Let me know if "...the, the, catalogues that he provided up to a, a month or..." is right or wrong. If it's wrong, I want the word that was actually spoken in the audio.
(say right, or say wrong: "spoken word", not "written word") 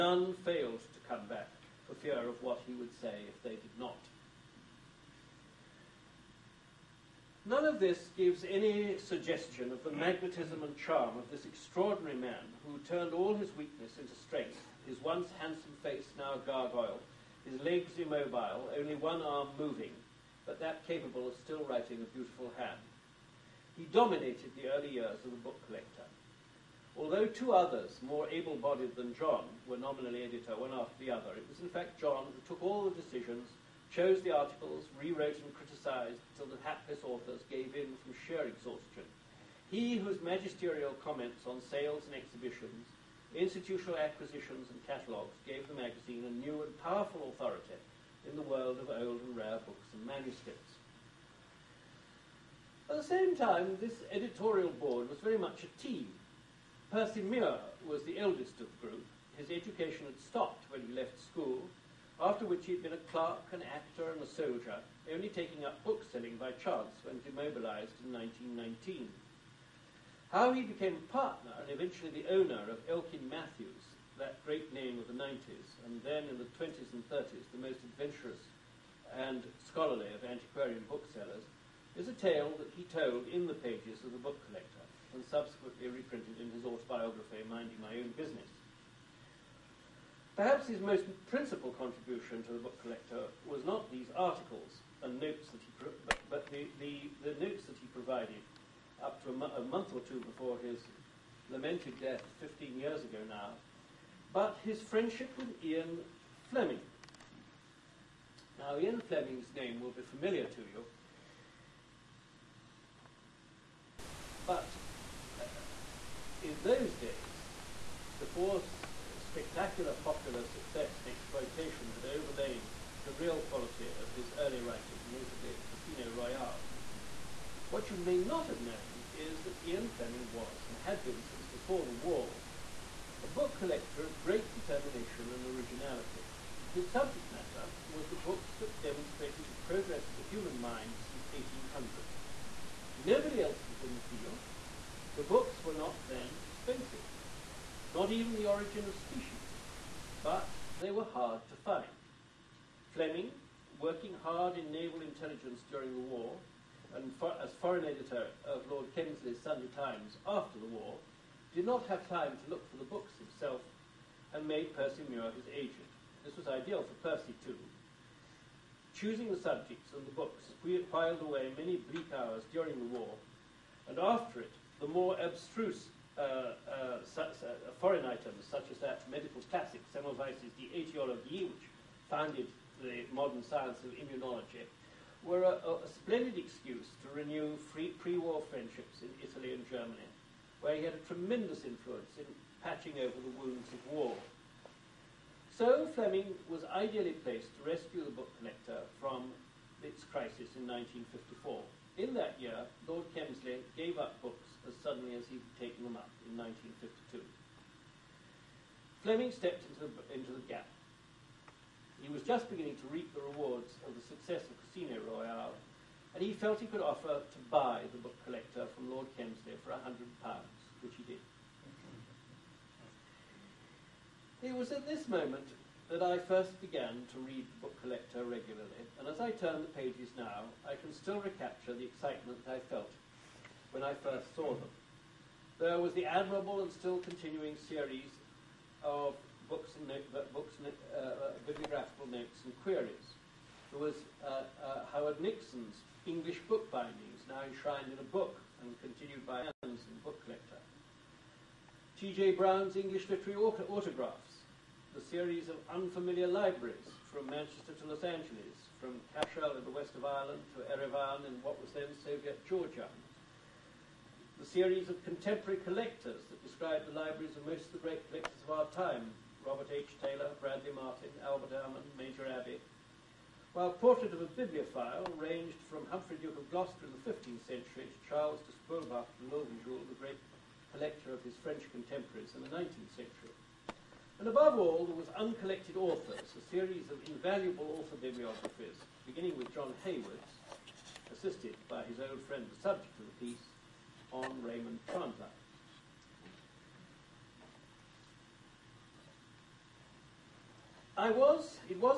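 wrong: "notes", not "catalogues".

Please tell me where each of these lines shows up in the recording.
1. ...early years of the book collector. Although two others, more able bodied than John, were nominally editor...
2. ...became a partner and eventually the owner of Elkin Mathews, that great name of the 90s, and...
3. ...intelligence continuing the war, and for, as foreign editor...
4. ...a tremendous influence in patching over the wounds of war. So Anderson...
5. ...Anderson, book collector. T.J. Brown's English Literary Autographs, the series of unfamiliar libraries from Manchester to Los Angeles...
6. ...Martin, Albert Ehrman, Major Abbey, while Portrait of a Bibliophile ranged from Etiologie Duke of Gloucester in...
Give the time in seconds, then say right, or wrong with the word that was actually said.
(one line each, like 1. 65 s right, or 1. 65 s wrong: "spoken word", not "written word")
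1. 24 s right
2. 70 s right
3. 155 s wrong: "during", not "continuing"
4. 190 s wrong: "Fleming", not "Anderson"
5. 249 s right
6. 270 s wrong: "Humphrey", not "Etiologie".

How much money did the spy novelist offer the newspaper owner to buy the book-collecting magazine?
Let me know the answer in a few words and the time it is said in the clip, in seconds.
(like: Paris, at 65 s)
£100, at 219 s.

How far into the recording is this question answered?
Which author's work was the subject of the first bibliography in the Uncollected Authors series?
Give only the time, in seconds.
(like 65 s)
294 s.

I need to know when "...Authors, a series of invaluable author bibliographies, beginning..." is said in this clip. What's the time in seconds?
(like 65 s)
285 s.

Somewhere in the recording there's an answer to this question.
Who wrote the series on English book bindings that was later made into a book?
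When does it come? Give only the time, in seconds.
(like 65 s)
244 s.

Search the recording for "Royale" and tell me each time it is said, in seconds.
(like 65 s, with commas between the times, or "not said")
126 s, 215 s.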